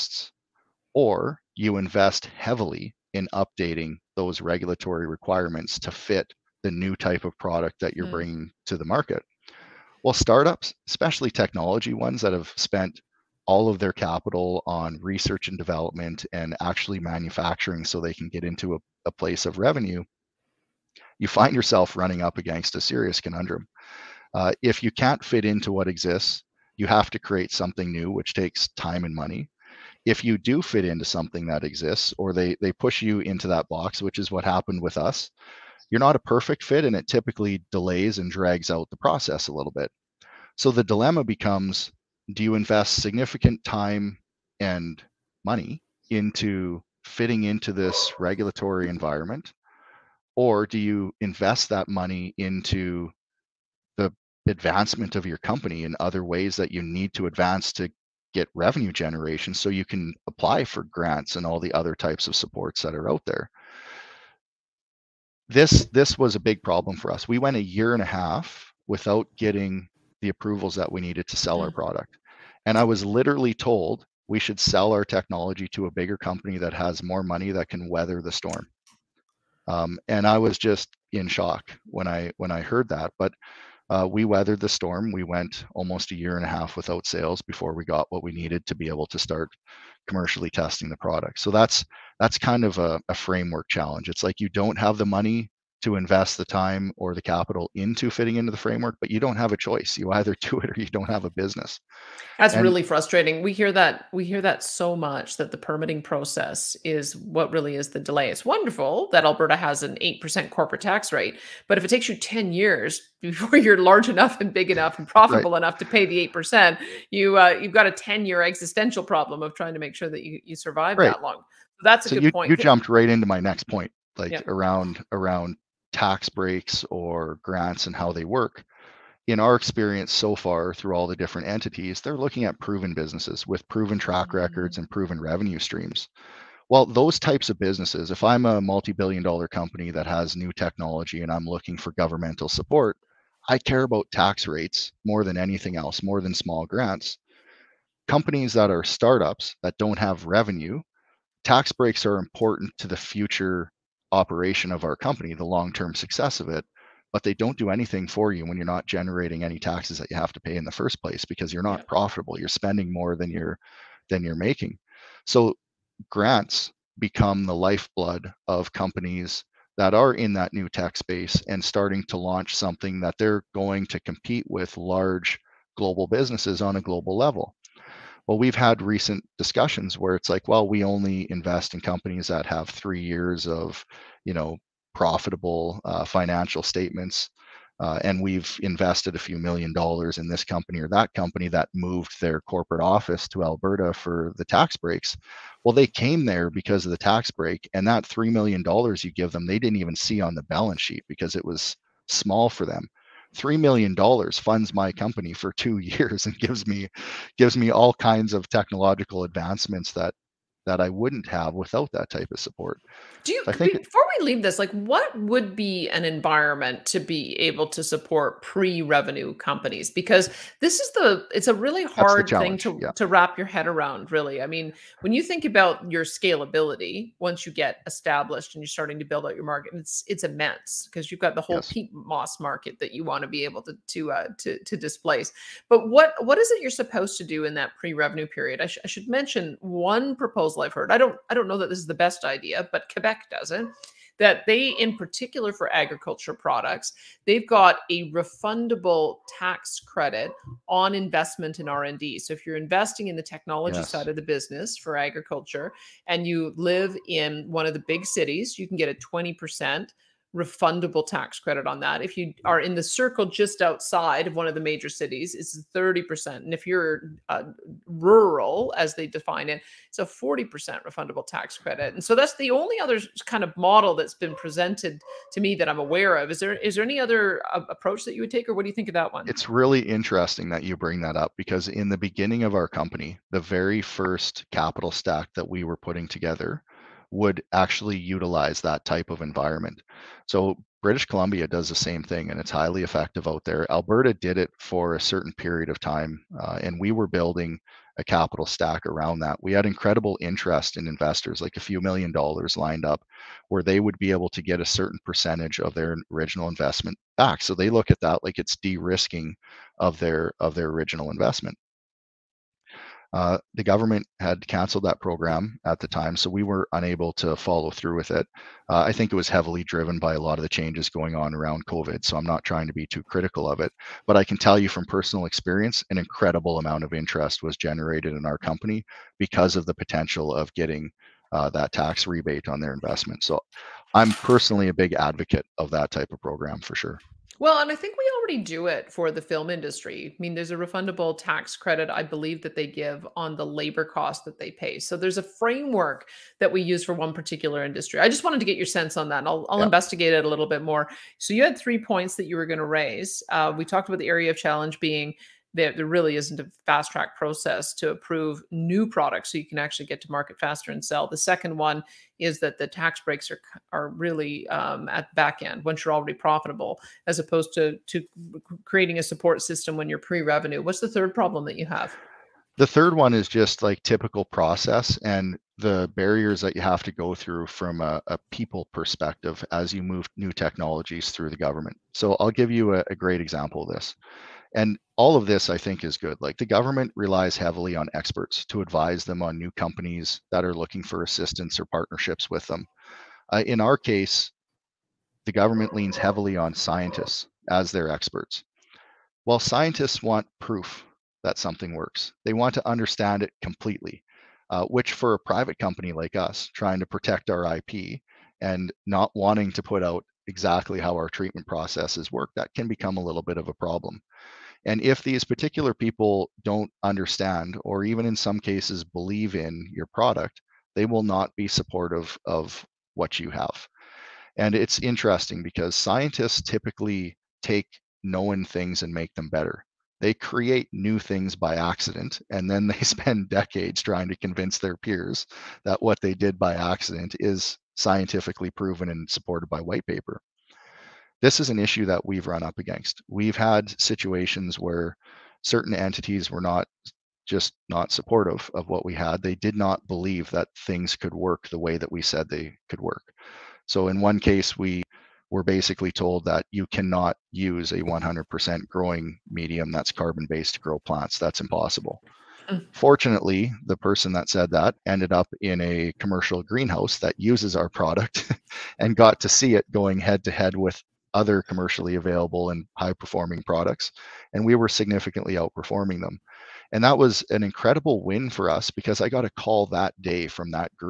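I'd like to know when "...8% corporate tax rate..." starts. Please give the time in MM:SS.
01:50.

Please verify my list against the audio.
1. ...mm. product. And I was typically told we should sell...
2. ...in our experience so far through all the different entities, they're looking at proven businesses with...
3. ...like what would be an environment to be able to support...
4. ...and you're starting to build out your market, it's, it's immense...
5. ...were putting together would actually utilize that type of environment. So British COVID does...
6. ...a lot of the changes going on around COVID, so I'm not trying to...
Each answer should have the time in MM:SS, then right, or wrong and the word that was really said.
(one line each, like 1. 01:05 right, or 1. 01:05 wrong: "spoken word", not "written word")
1. 01:11 wrong: "literally", not "typically"
2. 02:09 right
3. 03:34 right
4. 03:48 right
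5. 04:45 wrong: "Columbia", not "COVID"
6. 05:20 right.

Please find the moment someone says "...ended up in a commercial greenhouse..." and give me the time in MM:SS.
07:44.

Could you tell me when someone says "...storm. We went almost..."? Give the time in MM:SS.
01:24.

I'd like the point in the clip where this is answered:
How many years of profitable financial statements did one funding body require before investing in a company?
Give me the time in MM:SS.
03:02.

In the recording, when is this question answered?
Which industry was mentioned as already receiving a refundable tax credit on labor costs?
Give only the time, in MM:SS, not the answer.
05:39.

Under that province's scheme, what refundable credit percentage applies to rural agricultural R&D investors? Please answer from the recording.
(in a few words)
40%.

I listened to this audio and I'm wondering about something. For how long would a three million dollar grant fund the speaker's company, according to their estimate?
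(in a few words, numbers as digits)
2 years.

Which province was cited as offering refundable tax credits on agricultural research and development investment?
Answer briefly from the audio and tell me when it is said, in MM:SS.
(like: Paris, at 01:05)
Quebec, at 04:02.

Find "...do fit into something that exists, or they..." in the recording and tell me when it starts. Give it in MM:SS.
00:30.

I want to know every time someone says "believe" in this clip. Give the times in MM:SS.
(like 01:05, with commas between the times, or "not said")
05:42, 06:58, 07:29.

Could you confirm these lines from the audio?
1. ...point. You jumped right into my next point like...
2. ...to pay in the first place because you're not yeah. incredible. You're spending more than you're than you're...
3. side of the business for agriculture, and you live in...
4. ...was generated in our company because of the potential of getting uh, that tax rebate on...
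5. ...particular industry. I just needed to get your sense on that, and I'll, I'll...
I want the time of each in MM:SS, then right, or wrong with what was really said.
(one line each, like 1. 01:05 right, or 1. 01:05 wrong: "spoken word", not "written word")
1. 02:02 right
2. 02:40 wrong: "profitable", not "incredible"
3. 04:13 right
4. 05:27 right
5. 05:47 wrong: "wanted", not "needed".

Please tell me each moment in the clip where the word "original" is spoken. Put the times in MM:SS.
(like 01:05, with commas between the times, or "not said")
05:06, 05:10.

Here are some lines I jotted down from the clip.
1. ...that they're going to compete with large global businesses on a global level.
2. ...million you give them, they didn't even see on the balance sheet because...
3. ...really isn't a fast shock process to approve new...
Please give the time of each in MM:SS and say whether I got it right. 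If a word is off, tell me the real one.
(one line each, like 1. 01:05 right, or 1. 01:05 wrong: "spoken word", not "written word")
1. 02:52 right
2. 03:18 right
3. 05:55 wrong: "track", not "shock".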